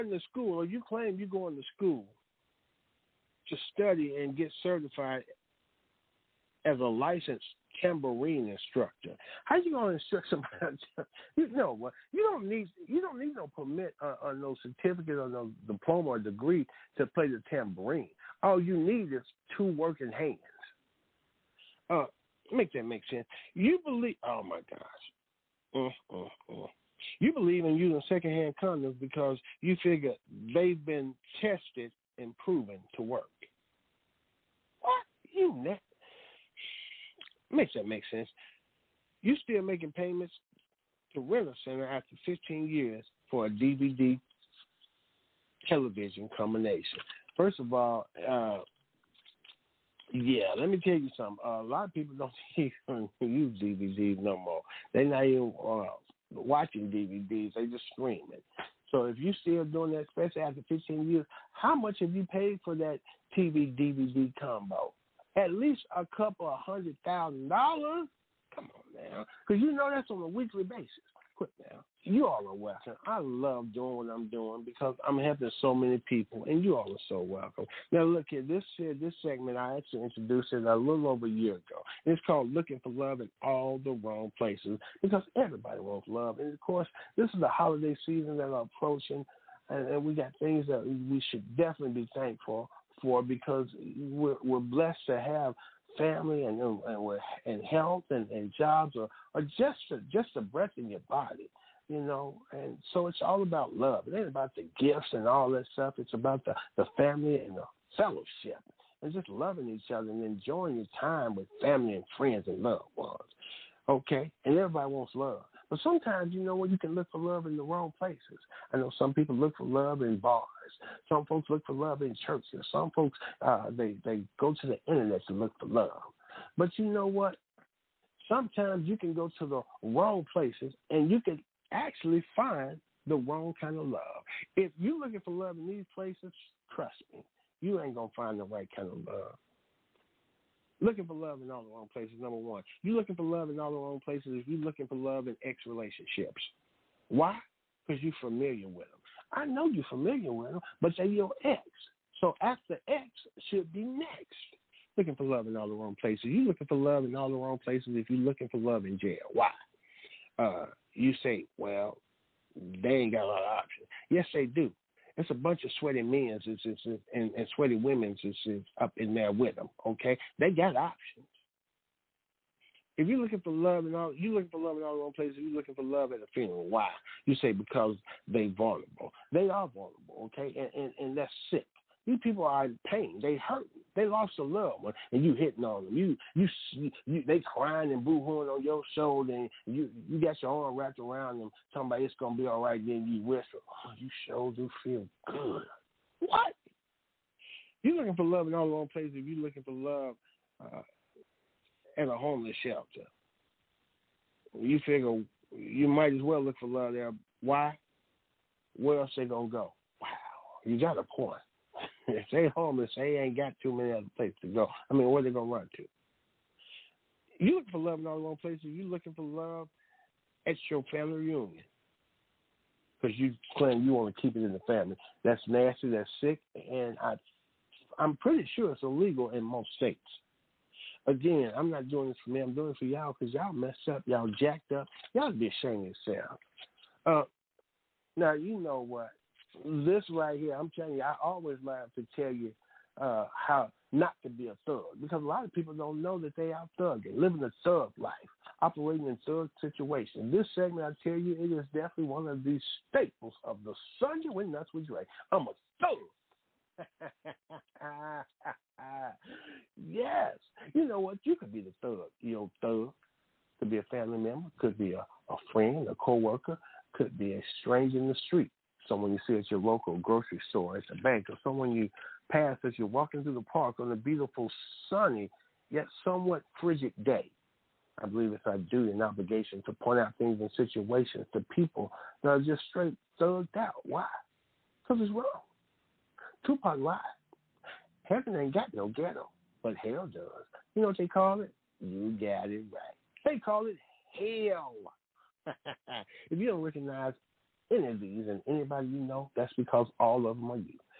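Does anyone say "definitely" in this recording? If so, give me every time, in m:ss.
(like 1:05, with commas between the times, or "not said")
1:31, 4:11.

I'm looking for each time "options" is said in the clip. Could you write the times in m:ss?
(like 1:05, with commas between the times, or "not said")
2:43, 2:50.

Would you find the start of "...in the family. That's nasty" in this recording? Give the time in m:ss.
3:44.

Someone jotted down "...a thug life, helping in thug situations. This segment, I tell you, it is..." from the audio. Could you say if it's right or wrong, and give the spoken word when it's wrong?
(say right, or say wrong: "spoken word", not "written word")
wrong: "operating", not "helping".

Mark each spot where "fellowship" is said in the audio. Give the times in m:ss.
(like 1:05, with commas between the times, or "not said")
1:47.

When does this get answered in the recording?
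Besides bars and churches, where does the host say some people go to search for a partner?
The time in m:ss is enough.
2:04.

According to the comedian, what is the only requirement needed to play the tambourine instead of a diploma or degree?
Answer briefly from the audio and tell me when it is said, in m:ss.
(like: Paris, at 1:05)
two working hands, at 0:19.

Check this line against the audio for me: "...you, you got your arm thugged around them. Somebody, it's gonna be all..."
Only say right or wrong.
wrong.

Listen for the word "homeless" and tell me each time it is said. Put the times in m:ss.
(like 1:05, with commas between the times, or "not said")
3:22, 3:32.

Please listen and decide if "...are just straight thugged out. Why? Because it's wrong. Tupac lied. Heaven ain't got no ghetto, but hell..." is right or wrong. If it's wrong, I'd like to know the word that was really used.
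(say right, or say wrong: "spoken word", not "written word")
right.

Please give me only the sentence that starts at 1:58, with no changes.
I know some people look for love in bars.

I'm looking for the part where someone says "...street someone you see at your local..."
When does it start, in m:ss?
4:28.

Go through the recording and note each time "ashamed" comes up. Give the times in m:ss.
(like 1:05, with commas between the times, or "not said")
3:55.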